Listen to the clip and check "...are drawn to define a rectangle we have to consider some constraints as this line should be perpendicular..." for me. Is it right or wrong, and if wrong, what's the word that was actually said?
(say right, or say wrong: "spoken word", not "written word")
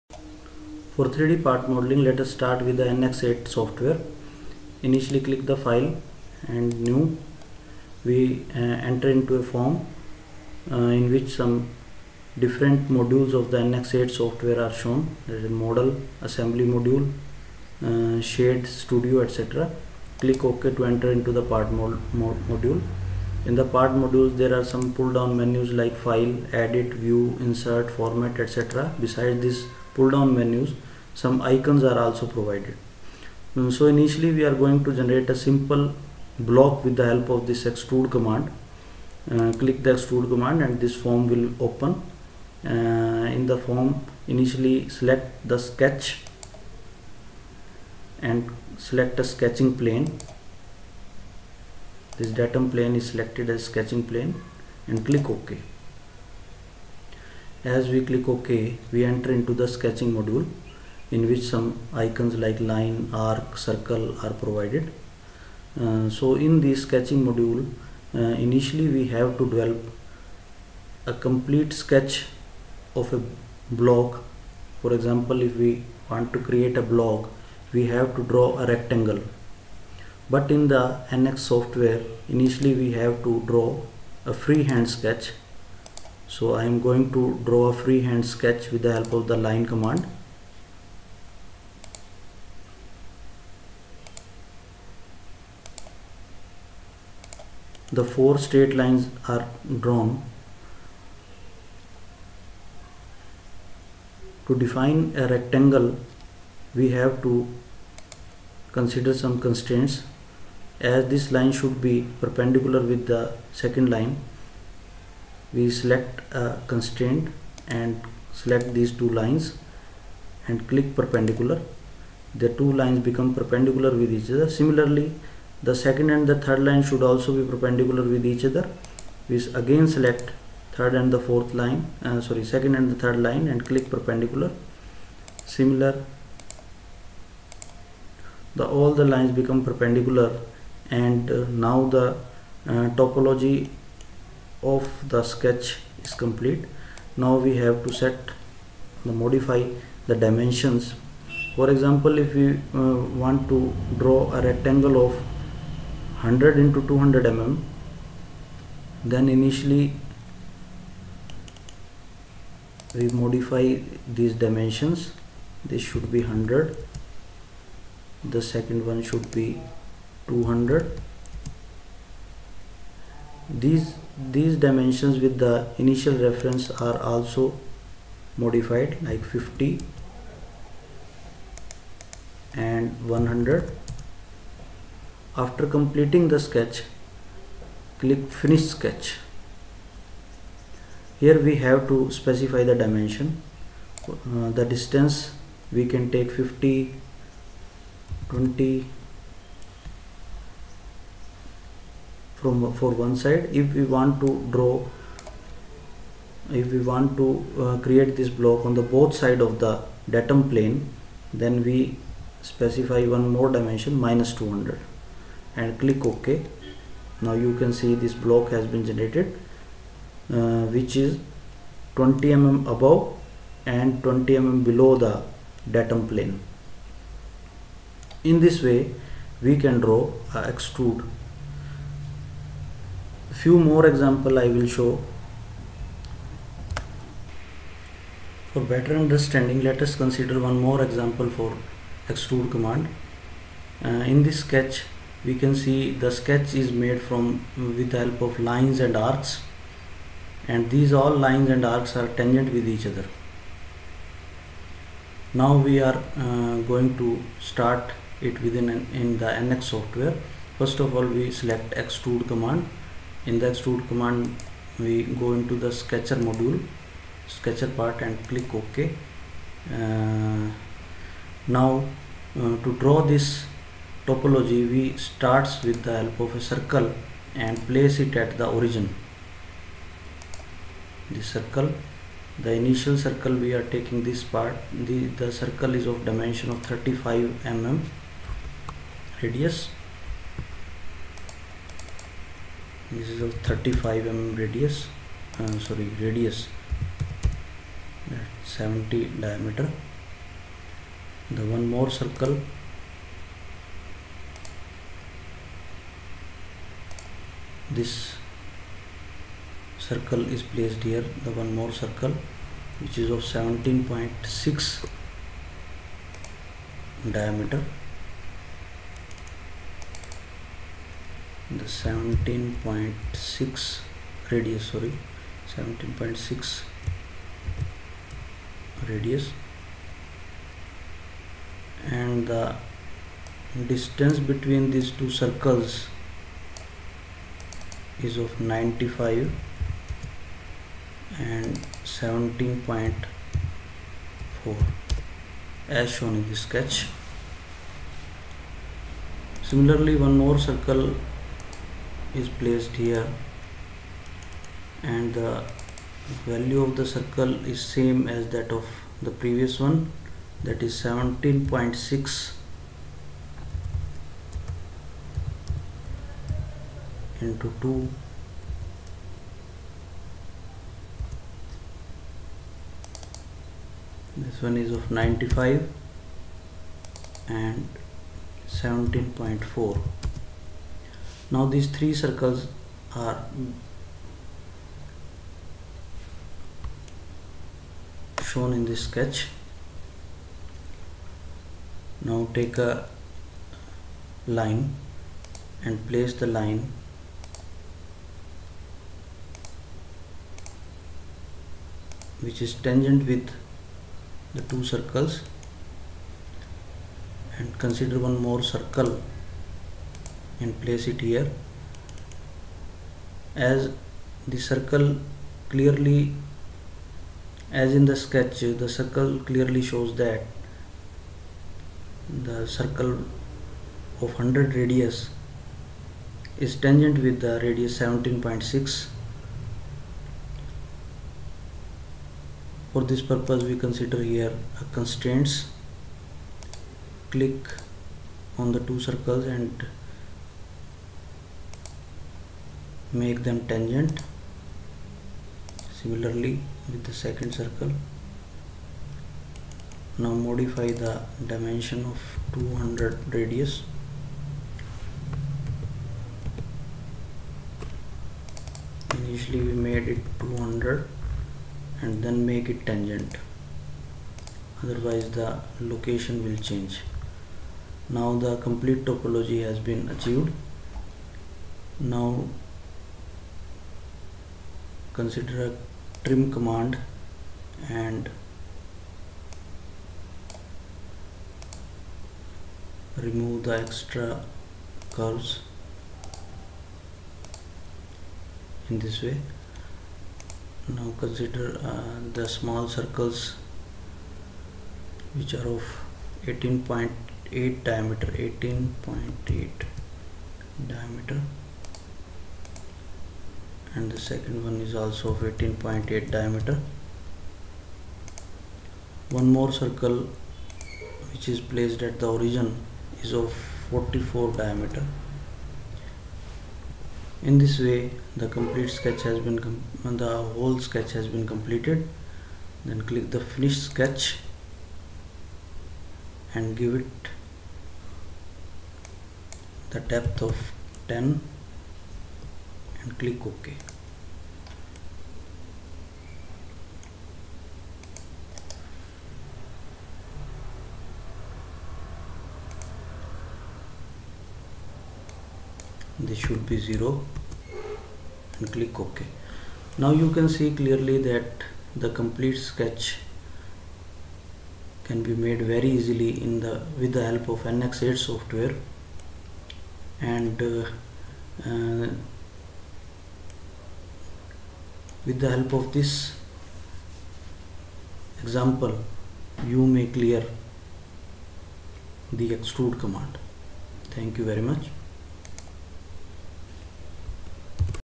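right.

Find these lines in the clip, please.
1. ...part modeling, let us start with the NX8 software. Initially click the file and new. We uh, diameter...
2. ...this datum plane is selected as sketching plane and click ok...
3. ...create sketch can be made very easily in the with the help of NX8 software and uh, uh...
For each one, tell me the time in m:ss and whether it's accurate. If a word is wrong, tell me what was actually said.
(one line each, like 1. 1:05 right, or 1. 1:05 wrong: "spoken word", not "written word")
1. 0:01 wrong: "enter", not "diameter"
2. 0:52 right
3. 9:11 wrong: "complete", not "create".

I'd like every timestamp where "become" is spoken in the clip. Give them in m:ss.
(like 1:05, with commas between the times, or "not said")
2:02, 2:19.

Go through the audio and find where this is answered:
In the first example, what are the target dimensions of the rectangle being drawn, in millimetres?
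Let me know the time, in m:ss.
2:36.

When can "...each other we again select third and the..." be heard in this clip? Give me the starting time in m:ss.
2:08.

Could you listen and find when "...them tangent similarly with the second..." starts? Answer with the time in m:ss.
7:23.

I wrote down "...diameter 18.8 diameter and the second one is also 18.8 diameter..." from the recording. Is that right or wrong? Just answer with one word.
right.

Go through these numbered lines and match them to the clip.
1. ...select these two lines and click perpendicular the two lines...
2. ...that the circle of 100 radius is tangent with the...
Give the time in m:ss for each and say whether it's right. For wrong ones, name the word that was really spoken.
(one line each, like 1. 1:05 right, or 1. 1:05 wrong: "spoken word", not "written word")
1. 1:58 right
2. 7:00 right.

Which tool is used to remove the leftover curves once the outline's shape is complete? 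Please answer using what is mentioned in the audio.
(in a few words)
trim command.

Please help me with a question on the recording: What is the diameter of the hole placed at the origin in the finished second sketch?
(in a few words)
44.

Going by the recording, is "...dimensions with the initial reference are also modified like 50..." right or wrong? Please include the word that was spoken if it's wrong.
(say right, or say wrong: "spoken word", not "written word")
right.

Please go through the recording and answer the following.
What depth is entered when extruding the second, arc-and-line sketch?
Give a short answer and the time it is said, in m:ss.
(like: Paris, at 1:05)
10, at 8:50.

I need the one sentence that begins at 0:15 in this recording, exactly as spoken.
There is a model, assembly module, uh, shape, studio, etc.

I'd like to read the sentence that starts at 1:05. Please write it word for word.
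Uh, so in the sketching module, uh, initially we have to develop a complete sketch of a block.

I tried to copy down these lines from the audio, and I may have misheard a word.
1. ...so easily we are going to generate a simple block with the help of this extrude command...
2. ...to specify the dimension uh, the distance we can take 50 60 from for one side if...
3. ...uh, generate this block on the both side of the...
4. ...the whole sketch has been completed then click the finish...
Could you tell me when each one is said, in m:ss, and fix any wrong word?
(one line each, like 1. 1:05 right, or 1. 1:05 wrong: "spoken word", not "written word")
1. 0:33 wrong: "initially", not "easily"
2. 3:11 wrong: "20", not "60"
3. 3:27 wrong: "create", not "generate"
4. 8:40 right.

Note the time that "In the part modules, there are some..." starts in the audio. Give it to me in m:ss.
0:23.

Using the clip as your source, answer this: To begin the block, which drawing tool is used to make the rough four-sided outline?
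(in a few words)
line command.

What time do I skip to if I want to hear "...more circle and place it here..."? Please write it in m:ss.
6:48.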